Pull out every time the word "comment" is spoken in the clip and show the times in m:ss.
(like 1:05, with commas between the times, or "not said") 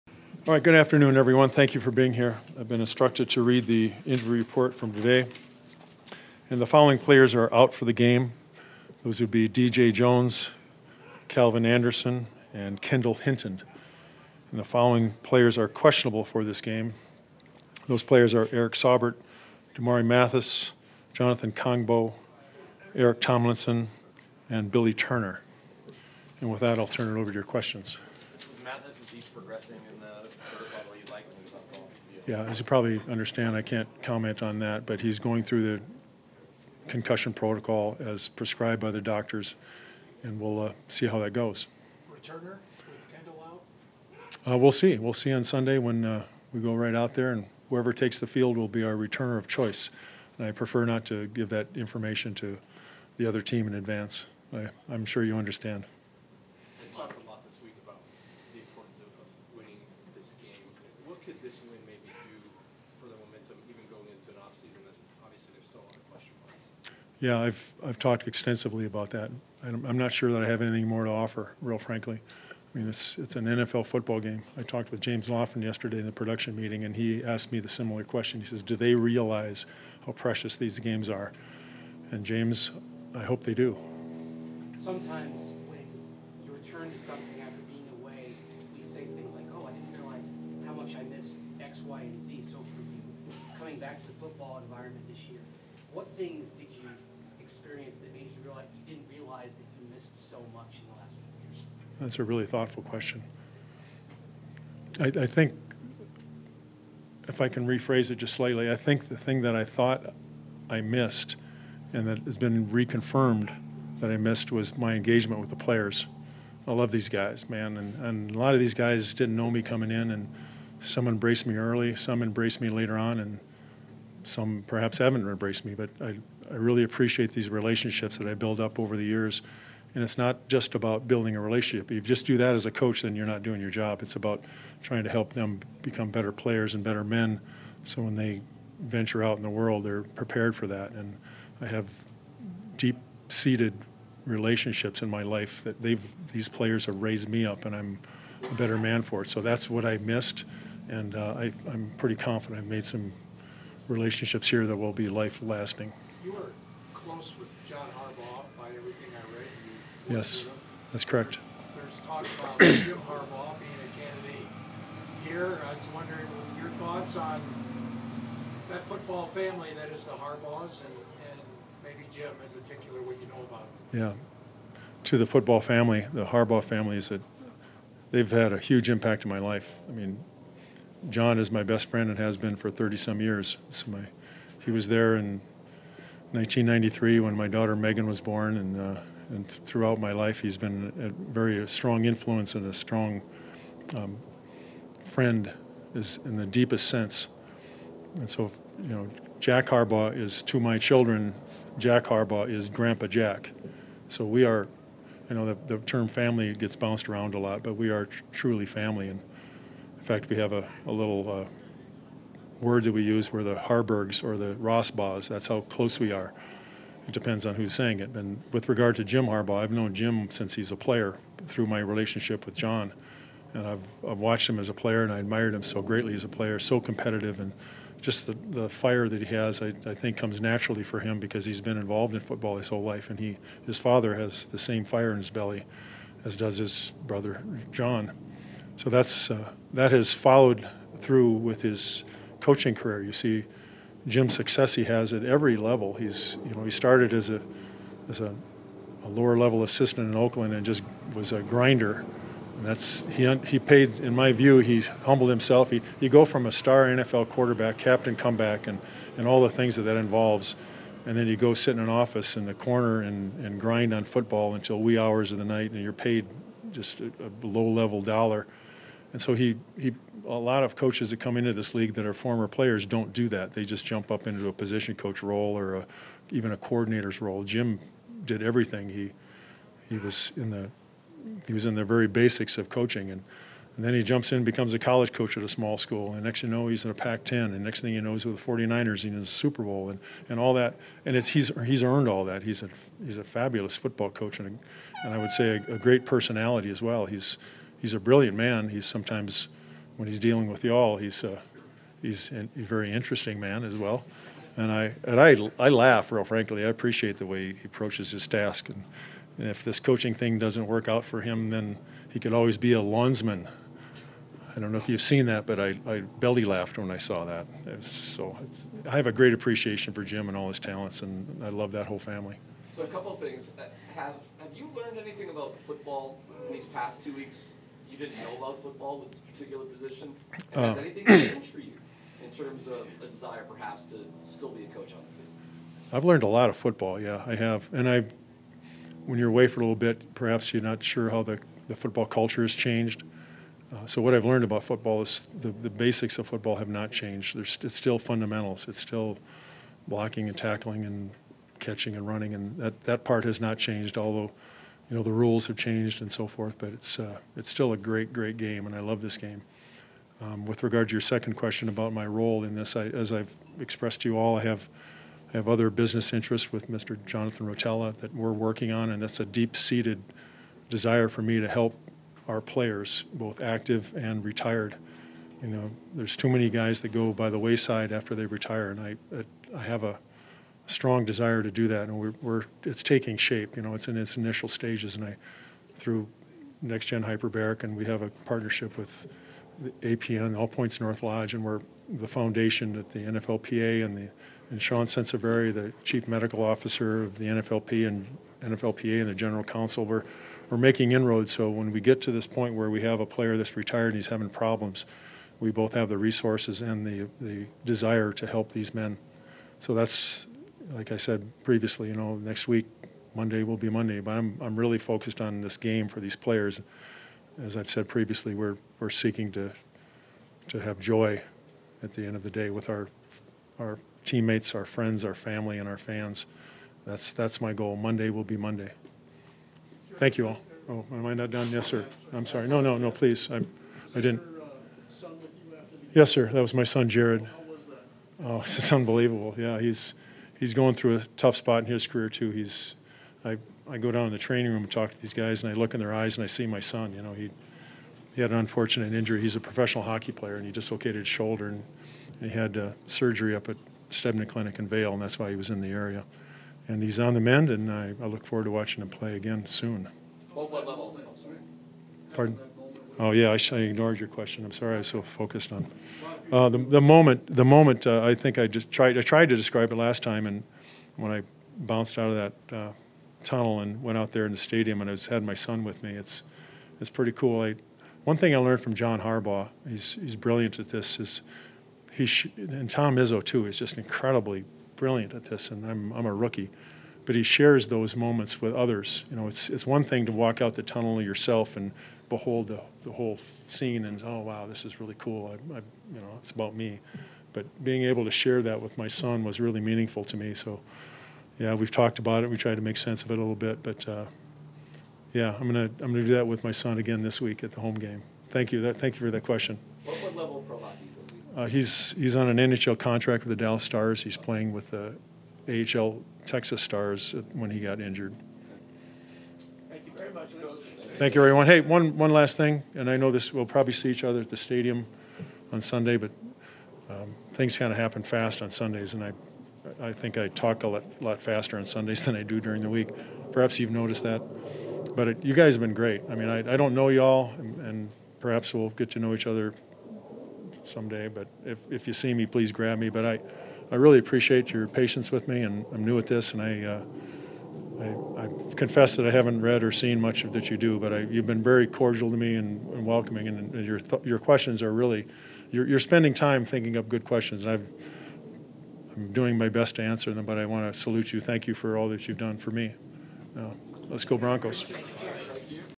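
0:34.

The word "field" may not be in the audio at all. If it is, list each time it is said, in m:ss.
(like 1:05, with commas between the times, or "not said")
0:48, 5:35.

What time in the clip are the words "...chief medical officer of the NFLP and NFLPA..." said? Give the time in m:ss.
6:35.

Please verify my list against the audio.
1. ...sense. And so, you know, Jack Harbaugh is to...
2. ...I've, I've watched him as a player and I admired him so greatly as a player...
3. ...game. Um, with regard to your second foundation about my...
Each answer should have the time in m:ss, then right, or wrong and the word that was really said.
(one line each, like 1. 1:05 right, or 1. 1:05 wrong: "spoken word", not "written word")
1. 3:16 right
2. 3:43 right
3. 5:59 wrong: "question", not "foundation".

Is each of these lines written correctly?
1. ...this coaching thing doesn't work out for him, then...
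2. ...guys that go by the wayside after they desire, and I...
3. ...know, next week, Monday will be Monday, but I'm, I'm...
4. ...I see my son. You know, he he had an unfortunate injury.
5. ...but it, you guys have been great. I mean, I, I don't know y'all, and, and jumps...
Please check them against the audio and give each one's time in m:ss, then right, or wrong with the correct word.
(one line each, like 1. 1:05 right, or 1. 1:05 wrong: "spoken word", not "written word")
1. 5:09 right
2. 6:16 wrong: "retire", not "desire"
3. 6:51 right
4. 7:26 right
5. 8:54 wrong: "perhaps", not "jumps".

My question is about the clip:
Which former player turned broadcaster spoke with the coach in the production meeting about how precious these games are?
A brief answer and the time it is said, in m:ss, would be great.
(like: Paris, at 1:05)
James Lofton, at 1:15.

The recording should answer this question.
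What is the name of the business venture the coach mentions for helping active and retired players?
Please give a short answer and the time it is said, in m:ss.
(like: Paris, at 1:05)
Next Gen Hyperbaric, at 6:26.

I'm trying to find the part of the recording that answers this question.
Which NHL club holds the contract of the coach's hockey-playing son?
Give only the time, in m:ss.
8:33.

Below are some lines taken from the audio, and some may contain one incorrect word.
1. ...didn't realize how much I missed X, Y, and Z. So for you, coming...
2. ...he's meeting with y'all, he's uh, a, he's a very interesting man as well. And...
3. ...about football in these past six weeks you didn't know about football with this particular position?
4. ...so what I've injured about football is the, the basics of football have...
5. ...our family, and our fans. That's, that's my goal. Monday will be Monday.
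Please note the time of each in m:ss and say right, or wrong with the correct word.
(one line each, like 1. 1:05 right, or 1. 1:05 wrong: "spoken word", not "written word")
1. 1:29 right
2. 5:00 wrong: "dealing", not "meeting"
3. 5:25 wrong: "two", not "six"
4. 5:43 wrong: "learned", not "injured"
5. 7:05 right.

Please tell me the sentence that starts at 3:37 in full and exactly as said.
It depends on who's saying it.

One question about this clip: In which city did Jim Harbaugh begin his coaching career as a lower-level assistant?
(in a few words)
Oakland.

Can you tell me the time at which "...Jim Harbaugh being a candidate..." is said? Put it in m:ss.
2:42.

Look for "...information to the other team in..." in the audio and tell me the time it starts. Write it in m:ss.
0:51.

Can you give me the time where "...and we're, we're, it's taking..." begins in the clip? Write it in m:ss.
6:21.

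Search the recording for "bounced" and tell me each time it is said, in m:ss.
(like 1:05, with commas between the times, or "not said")
3:26, 7:51.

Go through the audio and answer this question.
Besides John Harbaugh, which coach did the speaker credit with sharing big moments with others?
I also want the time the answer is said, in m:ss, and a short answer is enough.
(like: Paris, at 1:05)
Tom Izzo, at 8:02.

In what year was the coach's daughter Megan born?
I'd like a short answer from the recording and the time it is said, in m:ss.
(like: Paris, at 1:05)
1993, at 3:06.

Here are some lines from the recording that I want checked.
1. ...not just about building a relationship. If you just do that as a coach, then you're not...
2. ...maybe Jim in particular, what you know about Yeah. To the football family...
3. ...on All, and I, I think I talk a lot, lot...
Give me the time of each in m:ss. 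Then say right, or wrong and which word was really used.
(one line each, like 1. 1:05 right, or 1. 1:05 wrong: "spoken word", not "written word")
1. 2:10 right
2. 2:51 right
3. 8:48 wrong: "Sundays", not "All".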